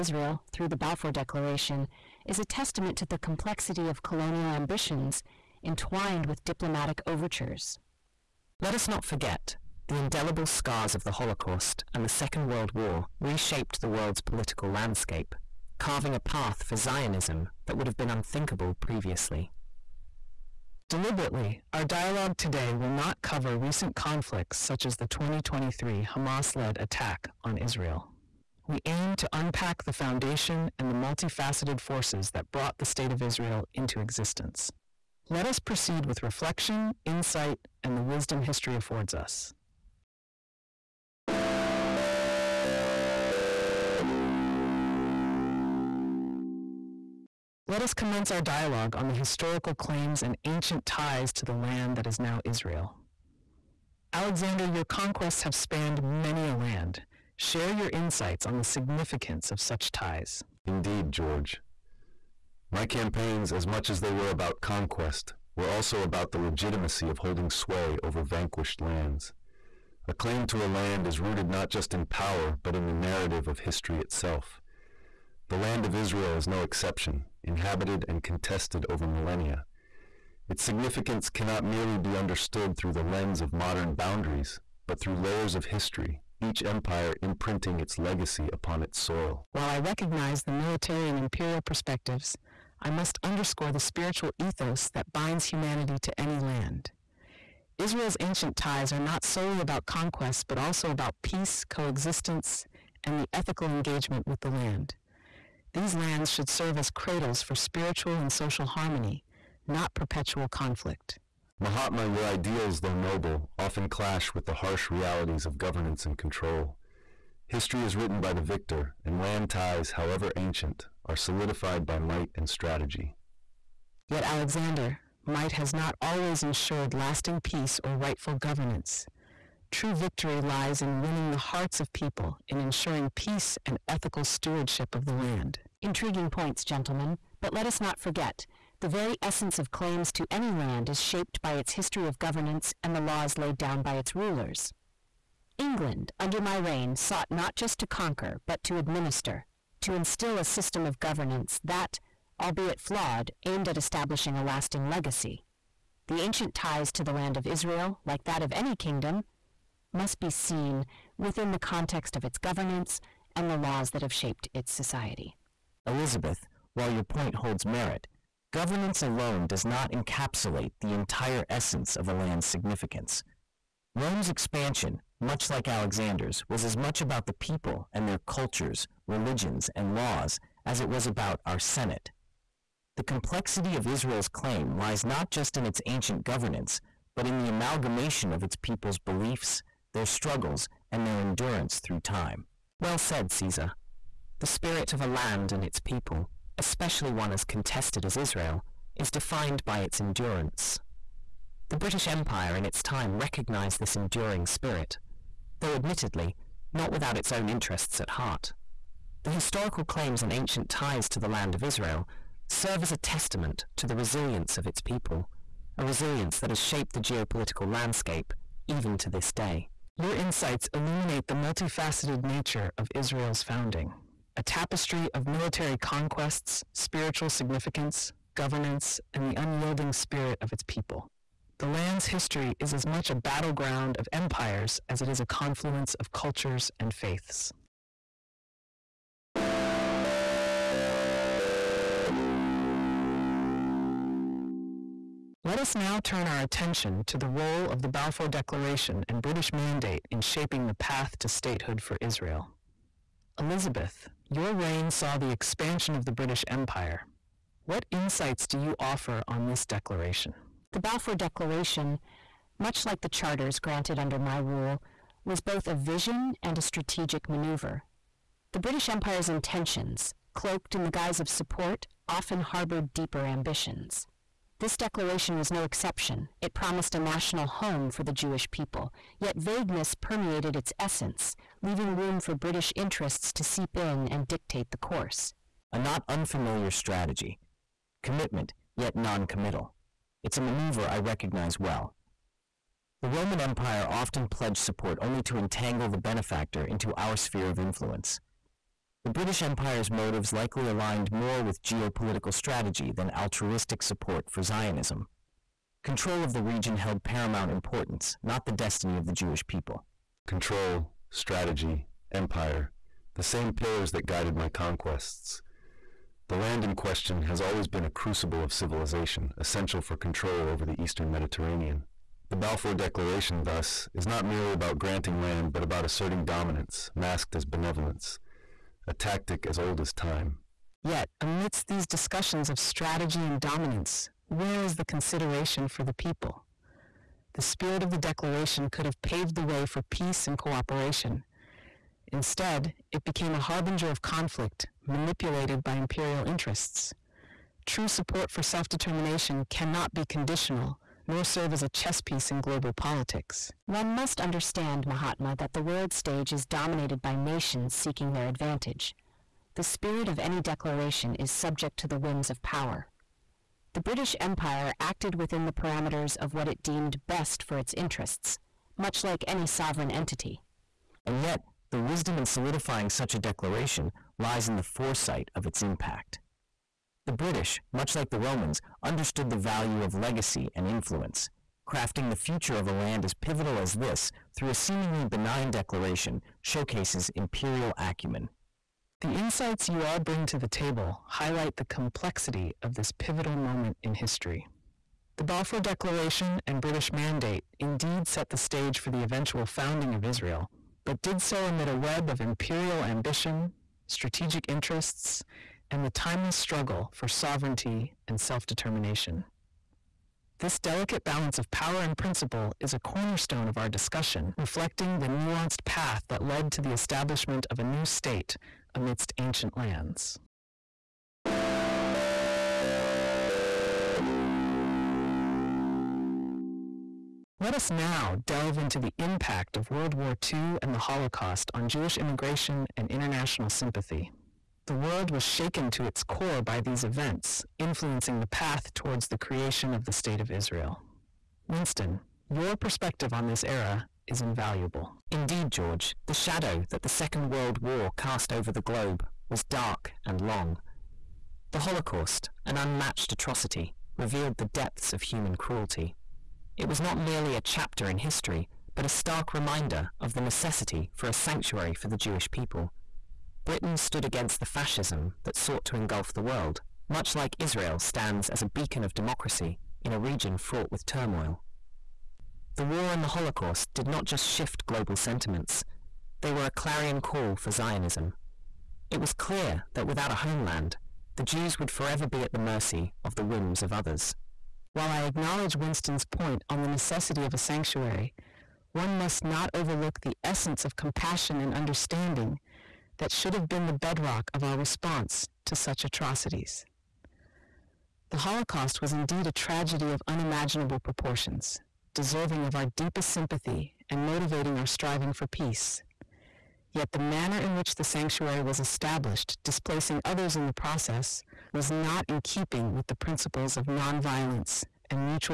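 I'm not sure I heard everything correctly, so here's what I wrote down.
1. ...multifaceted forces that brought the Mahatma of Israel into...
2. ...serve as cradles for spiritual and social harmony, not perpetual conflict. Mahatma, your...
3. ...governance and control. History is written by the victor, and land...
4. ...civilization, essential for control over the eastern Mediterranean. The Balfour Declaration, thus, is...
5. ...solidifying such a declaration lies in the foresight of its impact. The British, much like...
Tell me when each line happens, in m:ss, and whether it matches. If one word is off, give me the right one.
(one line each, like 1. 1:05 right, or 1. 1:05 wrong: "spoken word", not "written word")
1. 0:30 wrong: "State", not "Mahatma"
2. 1:46 right
3. 1:55 right
4. 5:18 right
5. 6:12 right.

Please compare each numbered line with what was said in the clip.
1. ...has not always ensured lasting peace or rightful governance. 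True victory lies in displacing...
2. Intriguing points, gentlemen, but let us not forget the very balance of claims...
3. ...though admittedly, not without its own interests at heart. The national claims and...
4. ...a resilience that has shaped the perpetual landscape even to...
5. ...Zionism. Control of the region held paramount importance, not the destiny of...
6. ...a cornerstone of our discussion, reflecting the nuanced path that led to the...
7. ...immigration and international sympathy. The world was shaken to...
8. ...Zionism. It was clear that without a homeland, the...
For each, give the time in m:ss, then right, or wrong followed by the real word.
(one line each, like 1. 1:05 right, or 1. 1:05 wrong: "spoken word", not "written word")
1. 2:05 wrong: "winning", not "displacing"
2. 2:15 wrong: "essence", not "balance"
3. 3:25 wrong: "historical", not "national"
4. 3:35 wrong: "geopolitical", not "perpetual"
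5. 5:04 right
6. 6:52 right
7. 7:11 right
8. 7:57 right.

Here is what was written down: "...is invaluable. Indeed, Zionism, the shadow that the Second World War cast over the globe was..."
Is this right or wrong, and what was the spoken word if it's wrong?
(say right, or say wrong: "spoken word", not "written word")
wrong: "George", not "Zionism".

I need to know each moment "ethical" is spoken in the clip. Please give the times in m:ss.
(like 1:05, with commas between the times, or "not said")
1:43, 2:13.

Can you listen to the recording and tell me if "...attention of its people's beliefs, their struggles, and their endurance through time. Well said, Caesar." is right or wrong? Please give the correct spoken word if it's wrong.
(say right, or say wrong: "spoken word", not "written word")
wrong: "amalgamation", not "attention".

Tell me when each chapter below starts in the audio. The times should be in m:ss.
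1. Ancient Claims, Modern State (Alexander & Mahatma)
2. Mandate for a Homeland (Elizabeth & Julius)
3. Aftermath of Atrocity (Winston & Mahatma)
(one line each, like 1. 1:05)
1. 0:40
2. 3:58
3. 7:00.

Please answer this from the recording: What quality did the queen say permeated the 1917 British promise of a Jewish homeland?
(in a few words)
vagueness.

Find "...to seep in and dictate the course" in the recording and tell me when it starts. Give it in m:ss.
4:43.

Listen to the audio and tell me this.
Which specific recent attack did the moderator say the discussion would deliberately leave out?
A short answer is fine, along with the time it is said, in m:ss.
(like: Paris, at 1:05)
2023 Hamas led attack, at 0:25.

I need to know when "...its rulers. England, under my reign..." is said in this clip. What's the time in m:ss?
2:23.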